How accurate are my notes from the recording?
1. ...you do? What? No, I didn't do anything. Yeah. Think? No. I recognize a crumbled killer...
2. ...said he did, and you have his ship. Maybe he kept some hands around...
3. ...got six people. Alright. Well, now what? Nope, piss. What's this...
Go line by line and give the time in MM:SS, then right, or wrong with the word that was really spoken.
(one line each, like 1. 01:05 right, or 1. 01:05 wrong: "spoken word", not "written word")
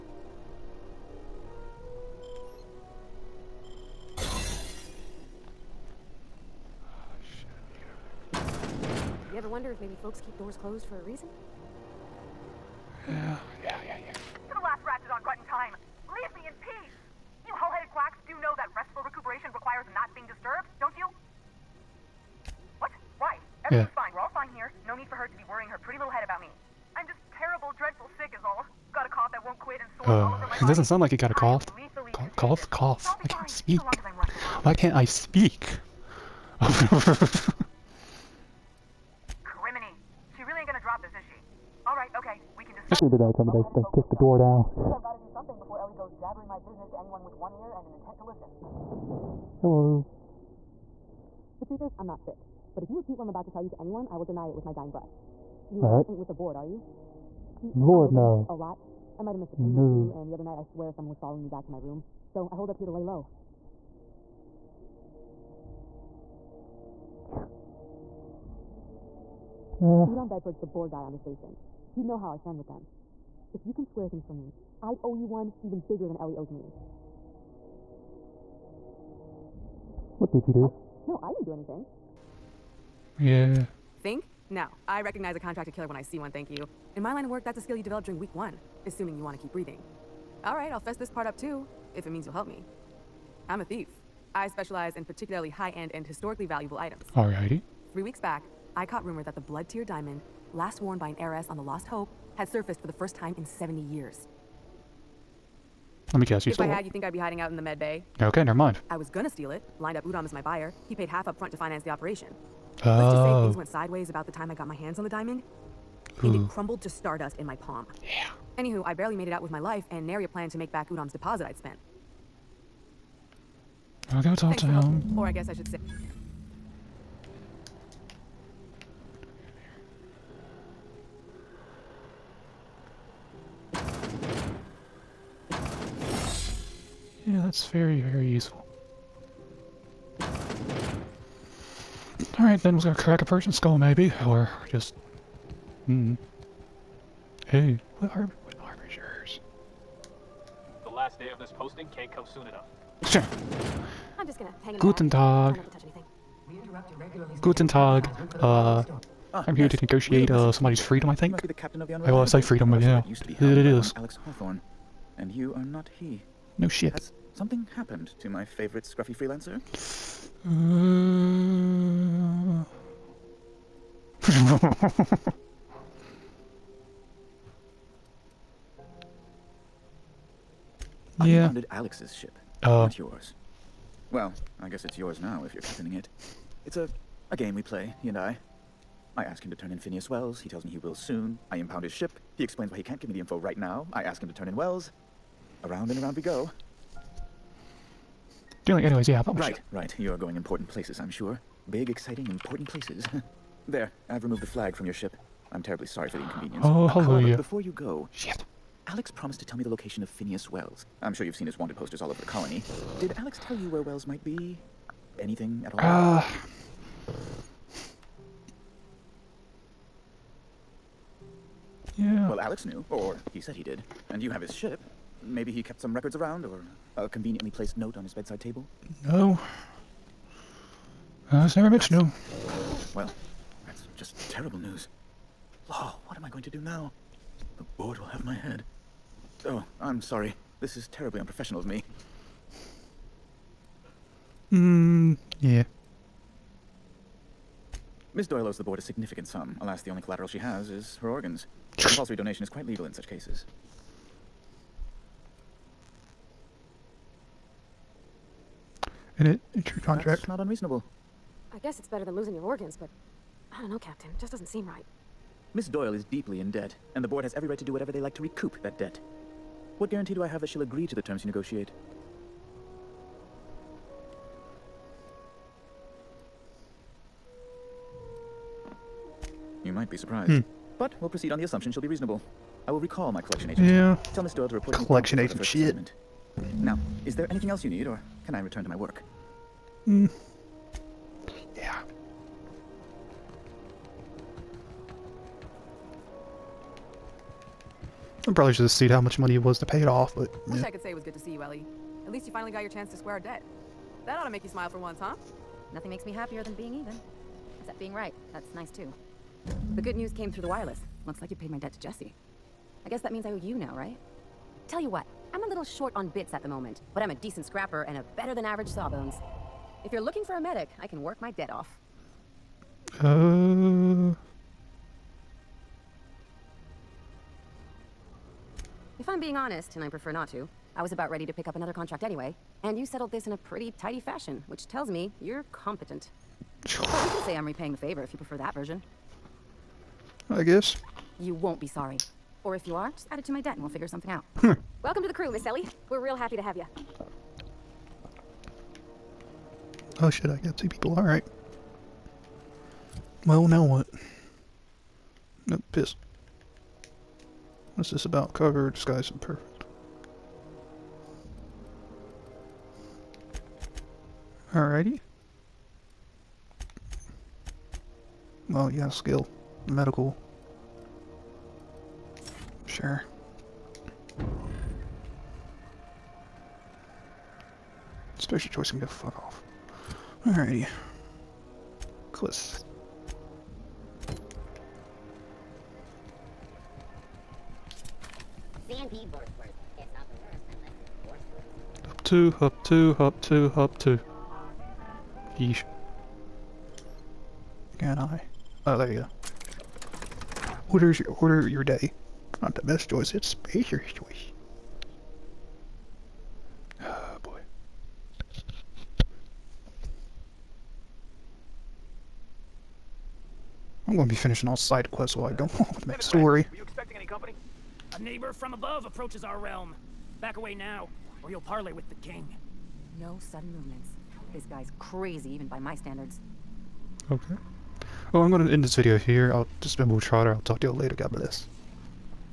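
1. 01:20 wrong: "contracted", not "crumbled"
2. 03:43 wrong: "records", not "hands"
3. 05:50 wrong: "two", not "six".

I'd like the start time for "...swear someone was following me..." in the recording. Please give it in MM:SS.
01:00.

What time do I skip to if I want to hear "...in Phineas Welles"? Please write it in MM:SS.
03:09.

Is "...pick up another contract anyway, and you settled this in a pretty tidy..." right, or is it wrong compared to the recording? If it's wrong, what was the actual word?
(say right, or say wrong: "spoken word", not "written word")
right.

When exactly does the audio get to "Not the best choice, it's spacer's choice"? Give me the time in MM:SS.
06:42.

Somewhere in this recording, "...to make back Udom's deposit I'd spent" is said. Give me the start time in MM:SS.
02:00.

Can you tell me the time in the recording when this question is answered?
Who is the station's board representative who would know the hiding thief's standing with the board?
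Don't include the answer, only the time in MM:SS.
01:10.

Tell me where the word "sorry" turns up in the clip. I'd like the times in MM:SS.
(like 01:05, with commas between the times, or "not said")
03:25, 04:00, 05:41.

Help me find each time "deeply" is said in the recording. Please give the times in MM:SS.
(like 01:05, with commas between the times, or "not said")
04:26.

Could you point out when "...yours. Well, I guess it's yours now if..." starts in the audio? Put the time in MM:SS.
03:02.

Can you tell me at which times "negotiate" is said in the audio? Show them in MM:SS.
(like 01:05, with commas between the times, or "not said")
02:39, 04:31.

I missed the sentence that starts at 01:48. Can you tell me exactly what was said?
I was gonna steal it, Lined up Udom as my buyer.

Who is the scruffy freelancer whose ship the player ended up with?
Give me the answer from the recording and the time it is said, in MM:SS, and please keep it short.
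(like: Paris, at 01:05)
Alex Hawthorne, at 02:43.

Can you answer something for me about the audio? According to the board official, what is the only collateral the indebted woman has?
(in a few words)
Her organs.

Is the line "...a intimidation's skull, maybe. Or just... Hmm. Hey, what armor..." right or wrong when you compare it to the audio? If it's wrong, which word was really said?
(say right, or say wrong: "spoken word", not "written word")
wrong: "person", not "intimidation".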